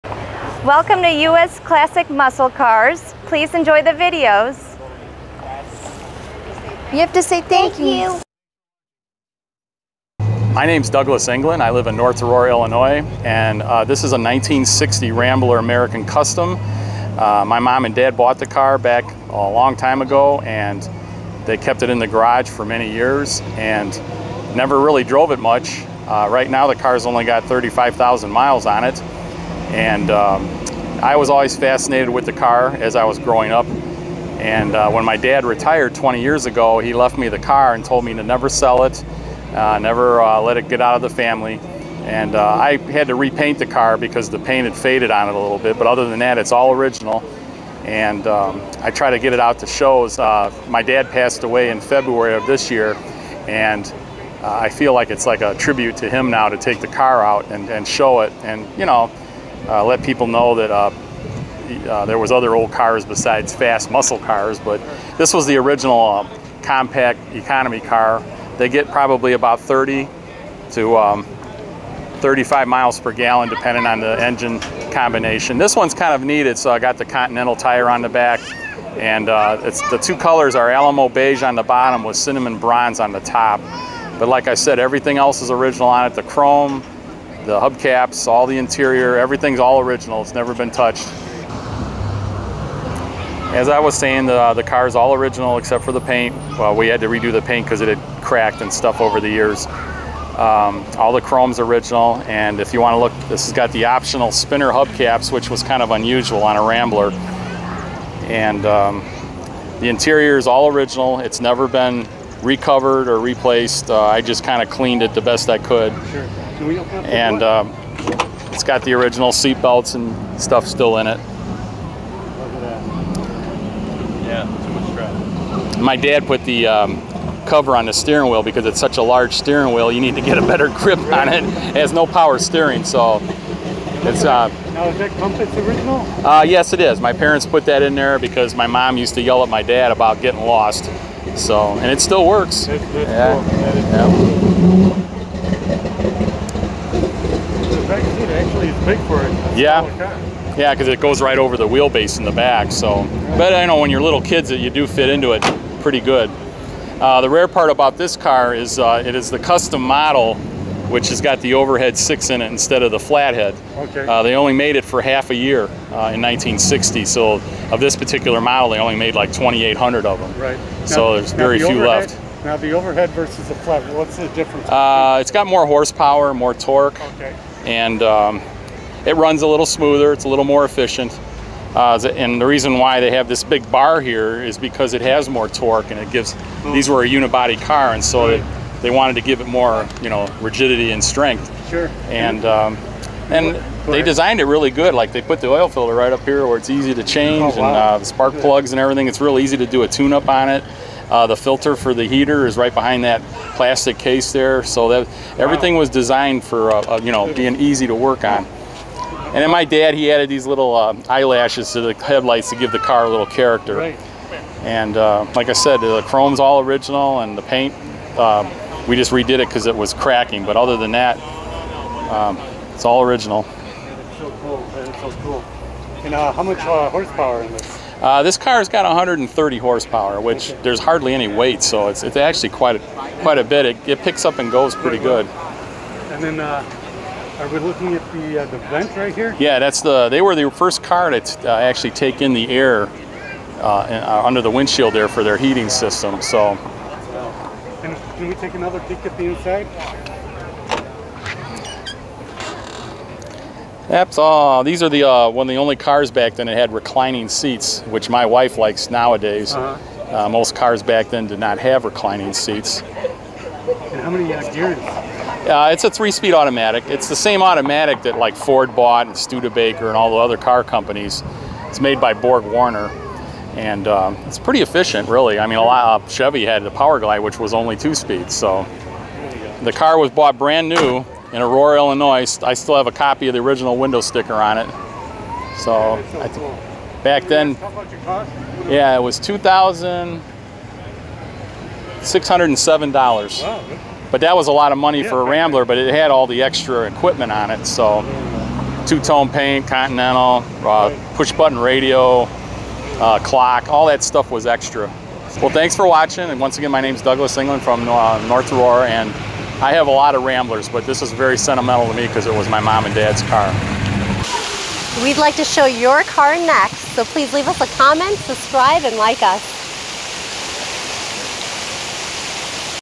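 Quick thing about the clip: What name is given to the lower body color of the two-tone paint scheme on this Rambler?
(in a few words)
Alamo beige.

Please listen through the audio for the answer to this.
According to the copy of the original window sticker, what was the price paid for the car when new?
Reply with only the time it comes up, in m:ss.
4:49.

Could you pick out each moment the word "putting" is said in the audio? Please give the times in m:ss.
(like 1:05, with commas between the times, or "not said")
not said.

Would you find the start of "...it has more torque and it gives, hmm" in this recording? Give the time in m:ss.
3:04.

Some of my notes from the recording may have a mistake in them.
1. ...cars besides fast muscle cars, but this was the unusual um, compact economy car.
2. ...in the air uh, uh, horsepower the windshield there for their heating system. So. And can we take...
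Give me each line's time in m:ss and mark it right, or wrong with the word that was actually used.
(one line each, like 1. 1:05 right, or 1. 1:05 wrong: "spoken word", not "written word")
1. 1:02 wrong: "original", not "unusual"
2. 4:02 wrong: "under", not "horsepower".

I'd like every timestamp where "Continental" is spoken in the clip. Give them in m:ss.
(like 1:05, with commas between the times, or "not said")
1:17, 4:59.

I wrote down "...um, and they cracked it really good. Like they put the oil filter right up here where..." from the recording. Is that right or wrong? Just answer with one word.
wrong.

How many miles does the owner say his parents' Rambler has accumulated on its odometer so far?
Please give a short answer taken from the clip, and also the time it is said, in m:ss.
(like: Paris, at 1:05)
35,000, at 0:27.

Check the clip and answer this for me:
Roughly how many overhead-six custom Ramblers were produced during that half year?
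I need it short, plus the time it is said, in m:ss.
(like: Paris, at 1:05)
2,800, at 2:49.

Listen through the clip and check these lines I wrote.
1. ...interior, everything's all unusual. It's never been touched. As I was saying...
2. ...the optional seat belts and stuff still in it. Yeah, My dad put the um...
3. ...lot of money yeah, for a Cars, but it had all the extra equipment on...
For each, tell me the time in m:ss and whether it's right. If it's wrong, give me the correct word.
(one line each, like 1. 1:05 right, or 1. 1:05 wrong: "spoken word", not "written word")
1. 1:28 wrong: "original", not "unusual"
2. 1:58 wrong: "original", not "optional"
3. 4:54 wrong: "Rambler", not "Cars".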